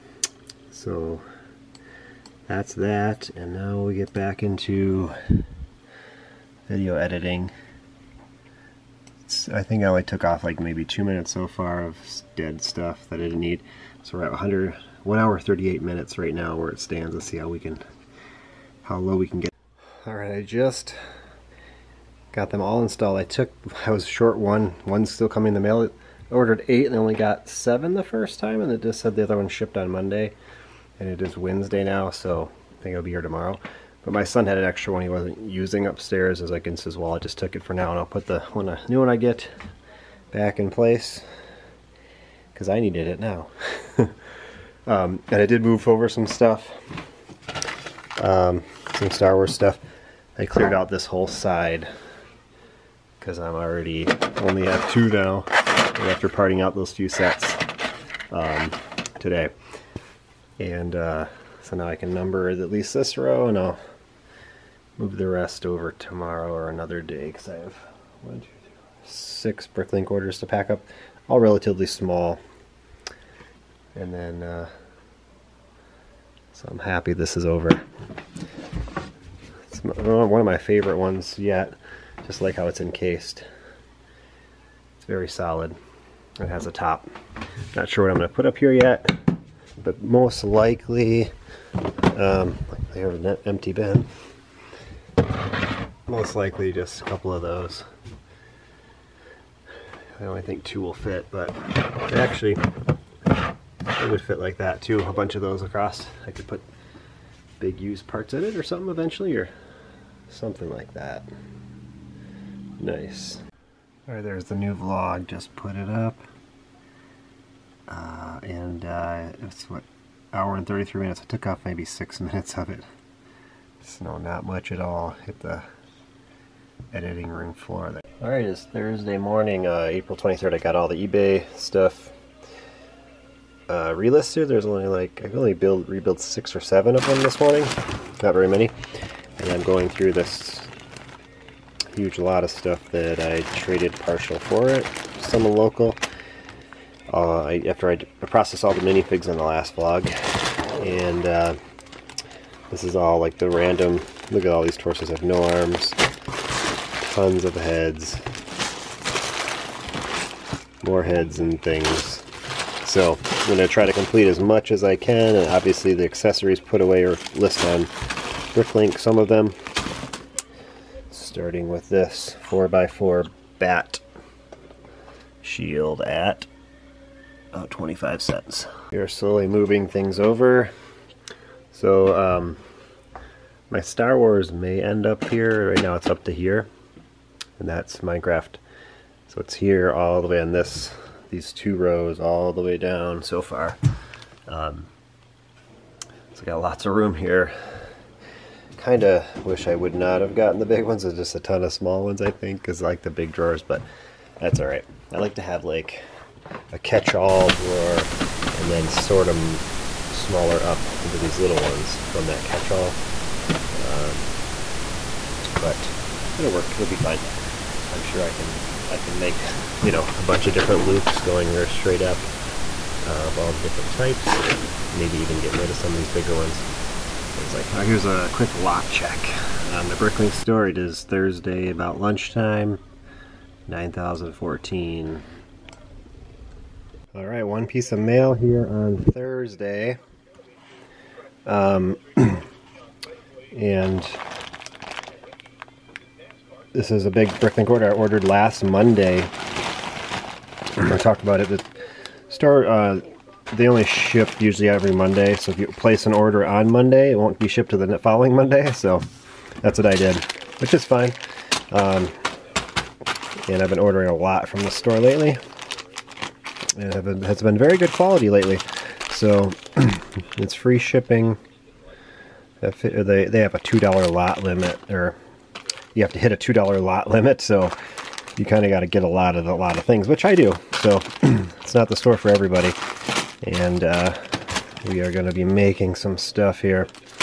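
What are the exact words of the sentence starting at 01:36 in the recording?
Most likely just a couple of those.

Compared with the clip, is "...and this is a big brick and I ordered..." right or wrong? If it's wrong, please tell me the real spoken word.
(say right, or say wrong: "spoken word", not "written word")
right.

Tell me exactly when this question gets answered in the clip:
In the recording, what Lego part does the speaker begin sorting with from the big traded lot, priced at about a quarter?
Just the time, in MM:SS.
02:52.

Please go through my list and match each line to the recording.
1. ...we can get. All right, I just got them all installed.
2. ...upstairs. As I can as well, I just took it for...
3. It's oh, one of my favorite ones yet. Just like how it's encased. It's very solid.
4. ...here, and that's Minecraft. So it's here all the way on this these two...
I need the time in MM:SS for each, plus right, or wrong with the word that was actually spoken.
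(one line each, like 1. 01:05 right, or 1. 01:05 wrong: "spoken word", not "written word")
1. 00:19 right
2. 00:35 right
3. 01:19 right
4. 03:06 right.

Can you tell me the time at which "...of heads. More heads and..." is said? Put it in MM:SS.
02:37.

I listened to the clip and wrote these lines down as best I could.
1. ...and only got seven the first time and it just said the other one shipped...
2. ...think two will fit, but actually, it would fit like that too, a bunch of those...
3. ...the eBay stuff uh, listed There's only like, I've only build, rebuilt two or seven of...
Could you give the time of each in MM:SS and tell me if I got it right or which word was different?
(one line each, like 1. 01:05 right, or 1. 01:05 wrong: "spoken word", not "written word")
1. 00:26 right
2. 01:40 right
3. 02:10 wrong: "six", not "two".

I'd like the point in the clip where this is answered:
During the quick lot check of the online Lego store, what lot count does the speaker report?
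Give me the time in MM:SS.
03:53.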